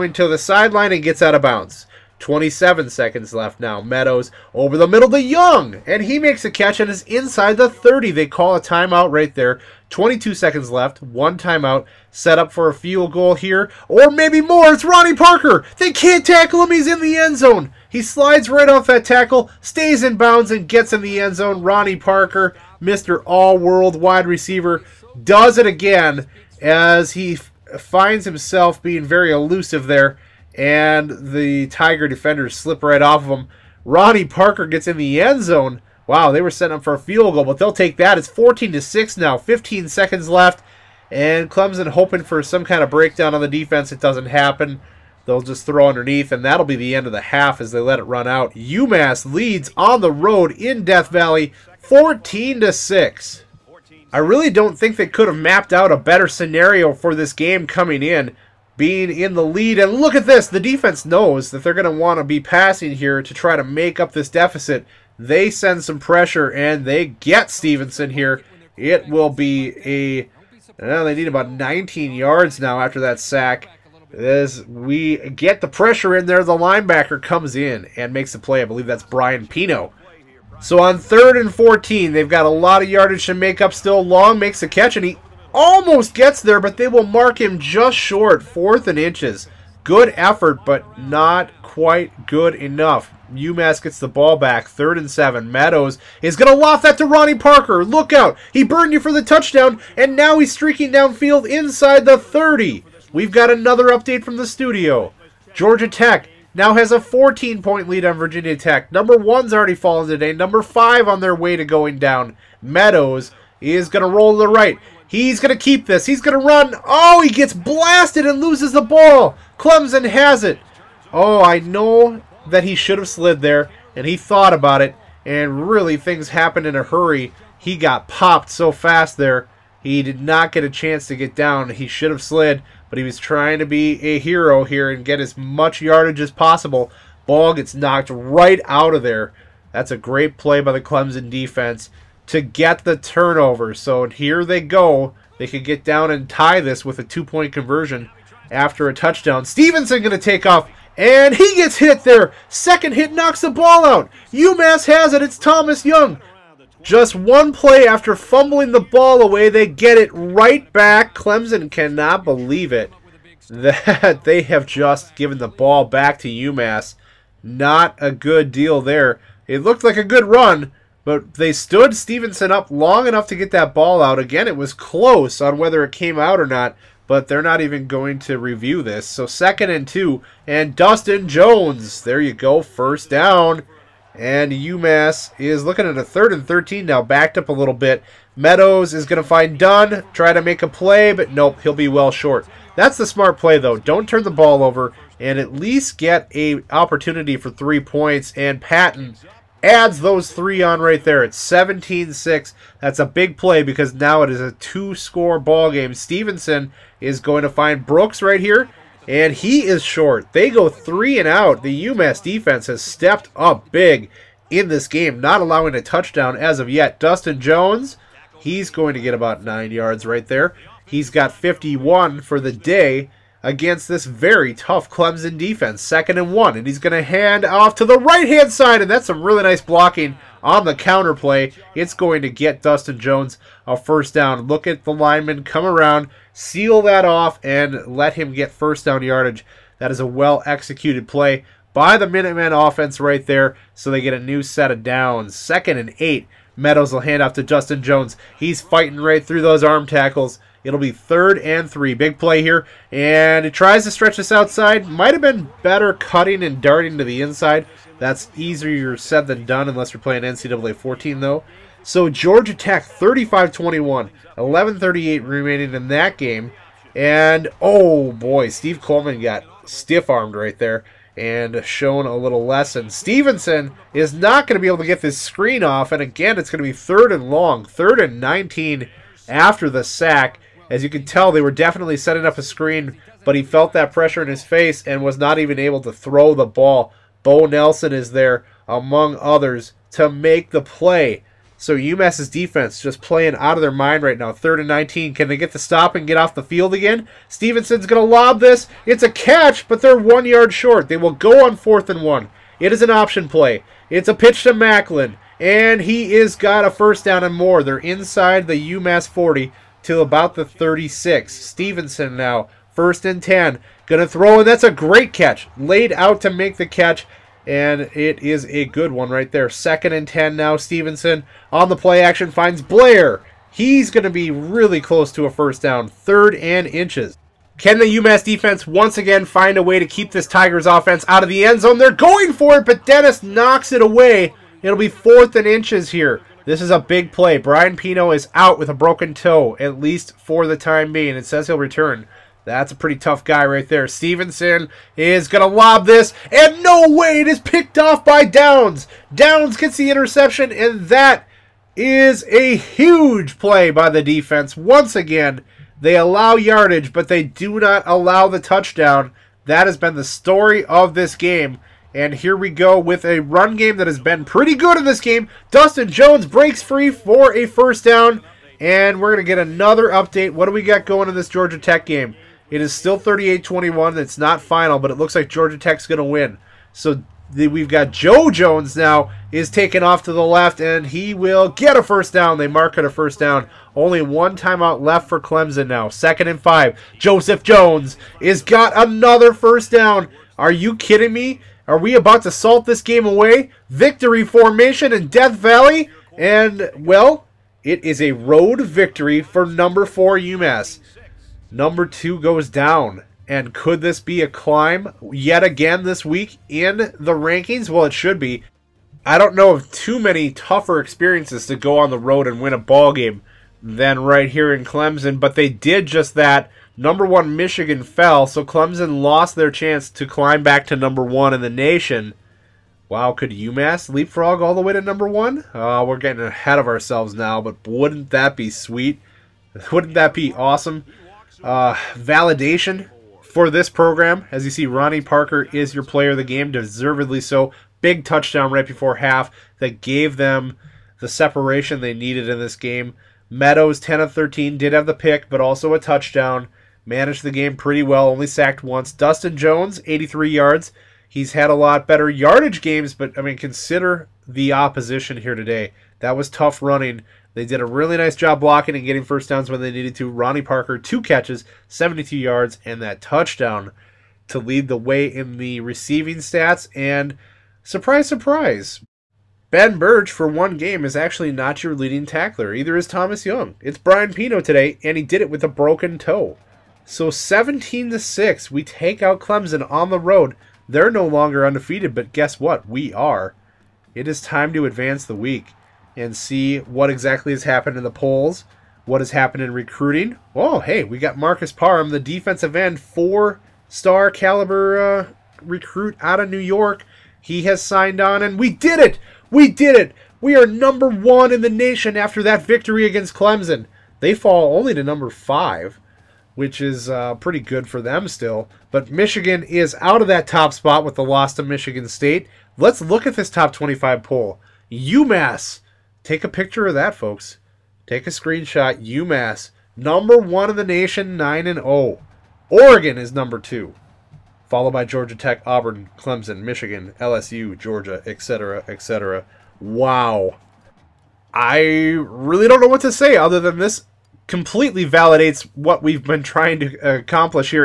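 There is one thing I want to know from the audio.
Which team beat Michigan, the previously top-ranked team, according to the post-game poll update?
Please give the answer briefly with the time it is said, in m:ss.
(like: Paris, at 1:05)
Michigan State, at 8:31.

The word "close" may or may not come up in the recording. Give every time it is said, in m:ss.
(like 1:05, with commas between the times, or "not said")
2:54, 5:24.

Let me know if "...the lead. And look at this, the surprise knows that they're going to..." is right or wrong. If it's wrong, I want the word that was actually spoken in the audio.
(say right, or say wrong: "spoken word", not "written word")
wrong: "defense", not "surprise".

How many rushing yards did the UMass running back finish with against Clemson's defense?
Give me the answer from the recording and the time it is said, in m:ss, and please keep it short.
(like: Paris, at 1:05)
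83, at 7:29.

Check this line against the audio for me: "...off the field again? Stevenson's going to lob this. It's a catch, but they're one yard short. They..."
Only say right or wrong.
right.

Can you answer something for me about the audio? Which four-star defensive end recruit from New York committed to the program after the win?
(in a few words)
Marcus Parham.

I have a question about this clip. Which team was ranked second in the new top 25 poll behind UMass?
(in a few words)
Oregon.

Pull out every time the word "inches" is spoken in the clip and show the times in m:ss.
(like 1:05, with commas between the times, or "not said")
1:28, 5:26, 5:35.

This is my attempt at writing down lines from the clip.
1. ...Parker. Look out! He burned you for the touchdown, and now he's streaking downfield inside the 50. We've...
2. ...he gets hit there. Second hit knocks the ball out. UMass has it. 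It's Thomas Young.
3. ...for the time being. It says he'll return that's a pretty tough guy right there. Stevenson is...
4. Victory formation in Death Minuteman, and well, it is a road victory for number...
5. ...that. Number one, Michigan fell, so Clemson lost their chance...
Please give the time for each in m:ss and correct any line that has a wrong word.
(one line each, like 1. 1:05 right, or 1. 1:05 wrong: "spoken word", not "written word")
1. 1:37 wrong: "30", not "50"
2. 2:31 right
3. 5:40 right
4. 6:33 wrong: "Valley", not "Minuteman"
5. 6:56 right.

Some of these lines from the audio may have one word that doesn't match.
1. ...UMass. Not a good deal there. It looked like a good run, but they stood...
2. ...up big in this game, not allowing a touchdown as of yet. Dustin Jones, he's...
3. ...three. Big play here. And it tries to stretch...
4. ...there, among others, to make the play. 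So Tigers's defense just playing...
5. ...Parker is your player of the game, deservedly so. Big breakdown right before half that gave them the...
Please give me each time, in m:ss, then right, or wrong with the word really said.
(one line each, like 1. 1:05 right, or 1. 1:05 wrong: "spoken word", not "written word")
1. 2:46 right
2. 3:33 right
3. 4:11 right
4. 4:48 wrong: "UMass", not "Tigers"
5. 7:15 wrong: "touchdown", not "breakdown".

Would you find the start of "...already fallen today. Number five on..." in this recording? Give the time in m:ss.
1:49.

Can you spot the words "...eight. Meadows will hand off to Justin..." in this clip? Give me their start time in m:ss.
4:05.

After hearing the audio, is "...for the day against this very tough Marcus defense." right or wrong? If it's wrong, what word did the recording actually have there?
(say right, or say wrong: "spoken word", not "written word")
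wrong: "Clemson", not "Marcus".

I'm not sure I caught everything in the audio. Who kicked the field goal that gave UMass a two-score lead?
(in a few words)
Patton.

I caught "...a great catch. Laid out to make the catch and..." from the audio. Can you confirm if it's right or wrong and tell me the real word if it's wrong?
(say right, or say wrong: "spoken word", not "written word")
right.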